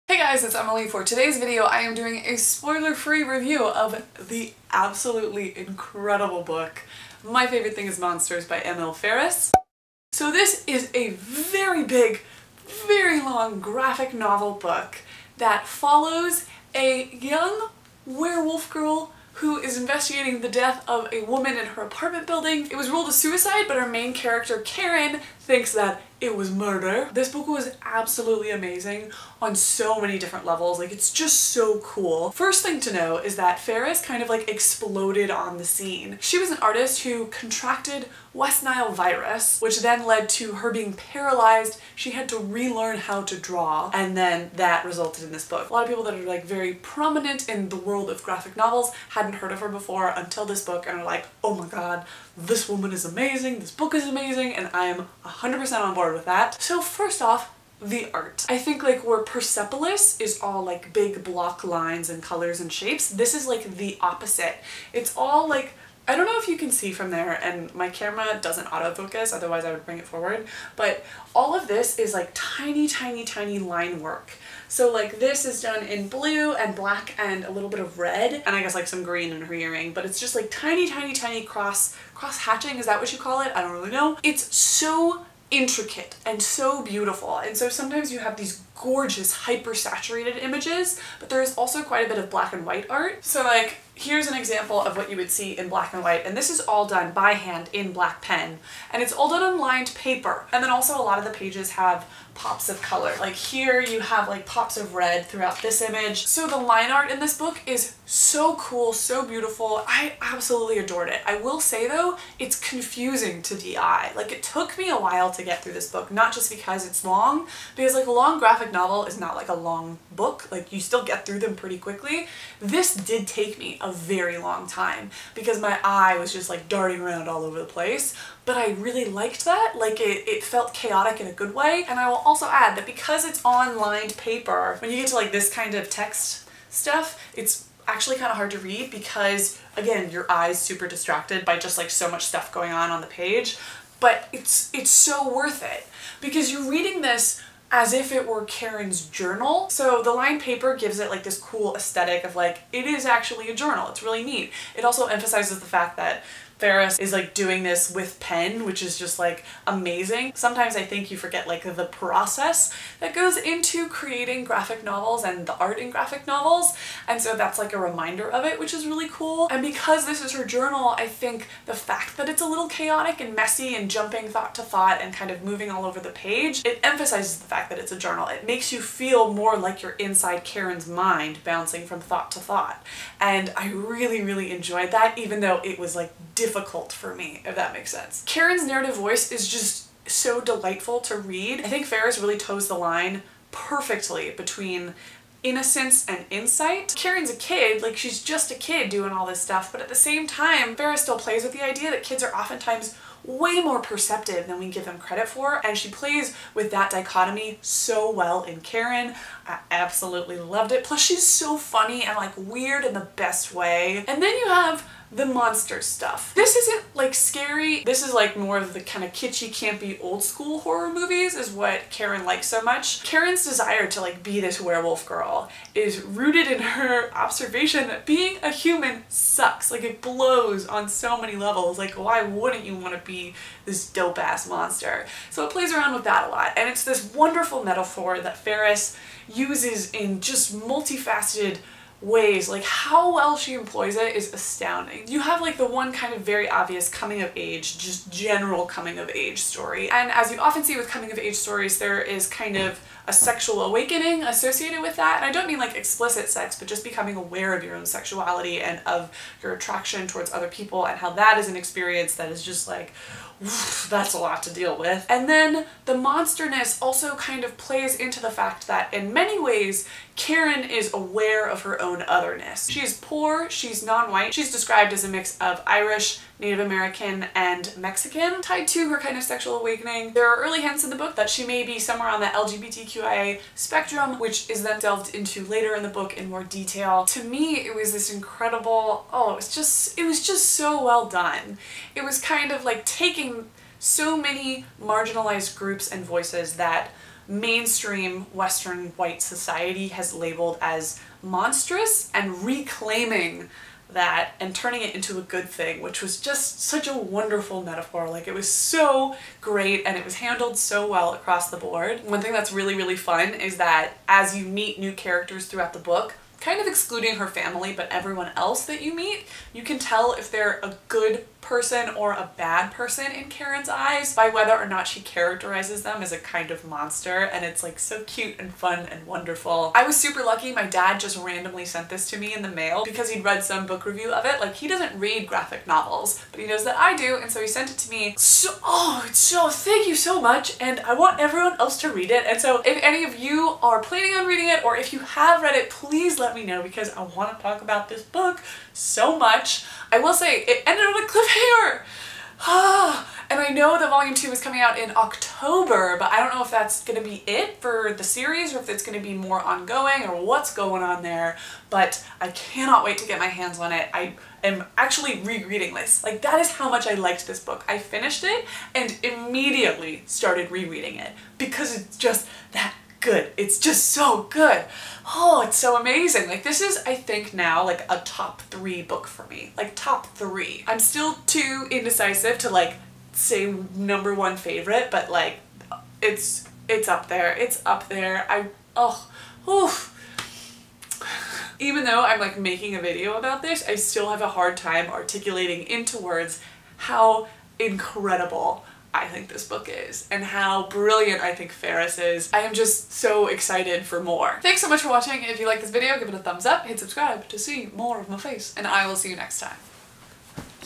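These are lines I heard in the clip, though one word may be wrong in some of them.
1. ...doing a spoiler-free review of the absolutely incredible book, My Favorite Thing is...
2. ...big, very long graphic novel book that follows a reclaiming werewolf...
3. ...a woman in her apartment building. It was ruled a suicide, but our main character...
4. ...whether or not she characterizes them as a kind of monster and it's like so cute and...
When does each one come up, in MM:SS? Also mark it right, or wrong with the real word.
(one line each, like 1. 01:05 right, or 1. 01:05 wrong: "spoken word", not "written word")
1. 00:01 right
2. 00:11 wrong: "young", not "reclaiming"
3. 00:21 right
4. 05:24 right.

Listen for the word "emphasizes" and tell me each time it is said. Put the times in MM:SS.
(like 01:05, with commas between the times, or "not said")
02:35, 02:56.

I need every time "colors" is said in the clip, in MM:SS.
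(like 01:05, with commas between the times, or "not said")
01:02, 01:42.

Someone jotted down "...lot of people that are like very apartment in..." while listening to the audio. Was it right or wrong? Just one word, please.
wrong.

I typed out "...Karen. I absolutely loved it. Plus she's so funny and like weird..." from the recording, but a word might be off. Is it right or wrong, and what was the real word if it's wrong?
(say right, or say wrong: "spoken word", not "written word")
right.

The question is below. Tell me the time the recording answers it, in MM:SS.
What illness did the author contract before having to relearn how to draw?
00:38.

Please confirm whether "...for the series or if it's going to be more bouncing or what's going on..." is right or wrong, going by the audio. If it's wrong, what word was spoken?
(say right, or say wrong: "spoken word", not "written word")
wrong: "ongoing", not "bouncing".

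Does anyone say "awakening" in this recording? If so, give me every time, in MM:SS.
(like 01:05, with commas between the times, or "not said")
04:13, 04:39.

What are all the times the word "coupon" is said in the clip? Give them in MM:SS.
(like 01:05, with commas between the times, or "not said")
not said.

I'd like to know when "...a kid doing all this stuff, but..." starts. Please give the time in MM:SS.
03:18.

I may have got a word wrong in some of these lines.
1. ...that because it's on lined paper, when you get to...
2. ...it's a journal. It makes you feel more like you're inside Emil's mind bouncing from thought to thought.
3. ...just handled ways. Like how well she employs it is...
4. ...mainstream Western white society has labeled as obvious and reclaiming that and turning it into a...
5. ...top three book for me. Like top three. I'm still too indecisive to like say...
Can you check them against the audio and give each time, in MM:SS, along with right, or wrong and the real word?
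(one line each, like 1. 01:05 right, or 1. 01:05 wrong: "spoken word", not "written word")
1. 02:12 right
2. 02:57 wrong: "Karen", not "Emil"
3. 04:00 wrong: "multifaceted", not "handled"
4. 04:57 wrong: "monstrous", not "obvious"
5. 06:18 right.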